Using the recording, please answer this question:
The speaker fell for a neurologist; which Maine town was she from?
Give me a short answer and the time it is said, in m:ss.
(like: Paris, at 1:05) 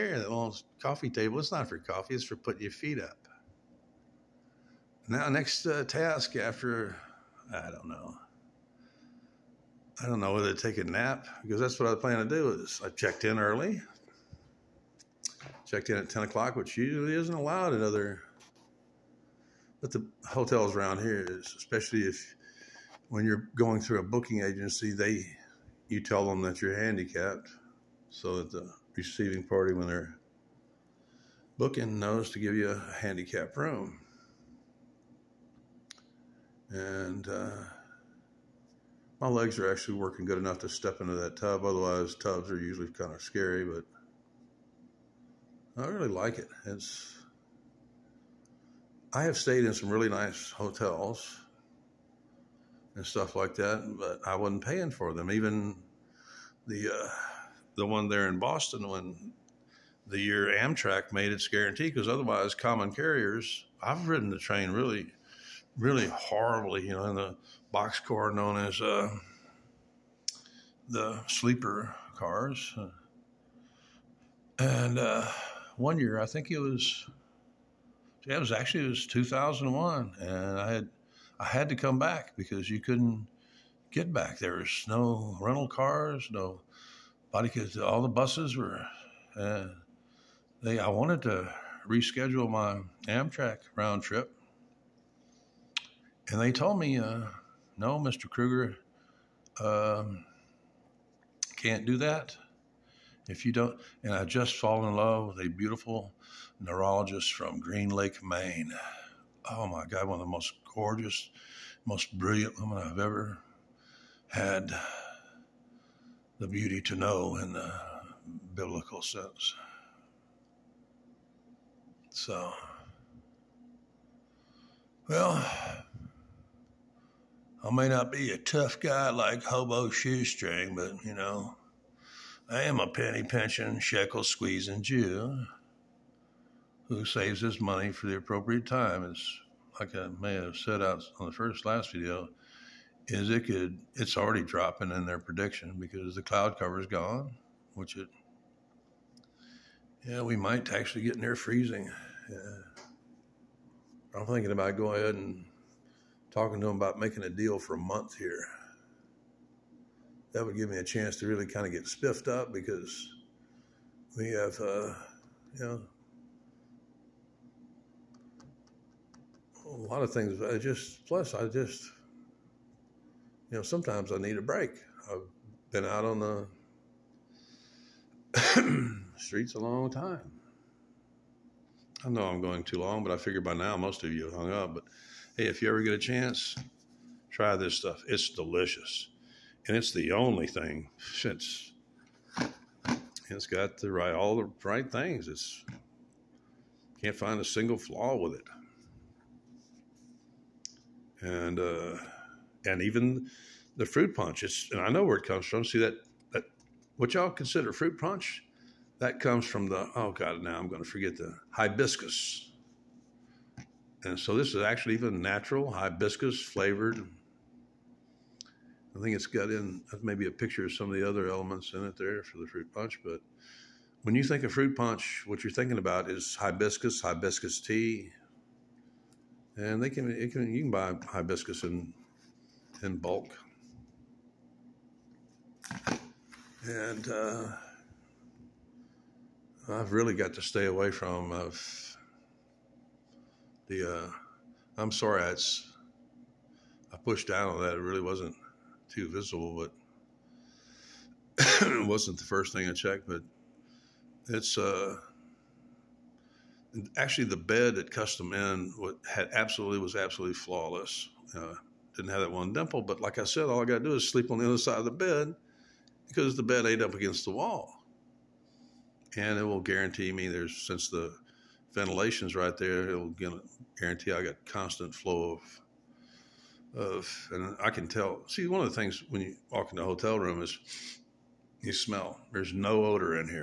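Green Lake, at 1:47.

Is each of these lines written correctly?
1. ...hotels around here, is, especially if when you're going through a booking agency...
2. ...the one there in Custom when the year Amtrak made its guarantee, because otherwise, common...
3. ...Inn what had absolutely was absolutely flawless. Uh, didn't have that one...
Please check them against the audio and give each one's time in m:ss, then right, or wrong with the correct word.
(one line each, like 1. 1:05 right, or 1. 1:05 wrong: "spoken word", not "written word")
1. 0:20 right
2. 0:57 wrong: "Boston", not "Custom"
3. 4:18 right.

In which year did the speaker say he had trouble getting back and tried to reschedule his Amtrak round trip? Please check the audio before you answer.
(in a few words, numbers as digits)
2001.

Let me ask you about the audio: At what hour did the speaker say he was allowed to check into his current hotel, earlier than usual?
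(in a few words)
10 o'clock.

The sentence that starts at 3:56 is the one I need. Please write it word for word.
And uh, I've really got to stay away from.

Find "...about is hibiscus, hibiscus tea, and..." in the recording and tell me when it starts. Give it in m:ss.
3:45.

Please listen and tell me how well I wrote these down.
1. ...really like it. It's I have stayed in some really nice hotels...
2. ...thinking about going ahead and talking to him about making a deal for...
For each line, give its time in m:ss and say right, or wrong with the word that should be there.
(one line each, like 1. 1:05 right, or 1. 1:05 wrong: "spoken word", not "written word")
1. 0:45 right
2. 2:34 right.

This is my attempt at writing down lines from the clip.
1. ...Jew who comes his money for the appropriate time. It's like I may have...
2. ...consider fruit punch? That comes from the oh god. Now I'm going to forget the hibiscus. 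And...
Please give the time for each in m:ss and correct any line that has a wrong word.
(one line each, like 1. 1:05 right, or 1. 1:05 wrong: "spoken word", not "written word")
1. 2:14 wrong: "saves", not "comes"
2. 3:27 right.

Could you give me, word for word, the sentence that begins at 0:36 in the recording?
And uh, my legs are actually working good enough to step into that tub.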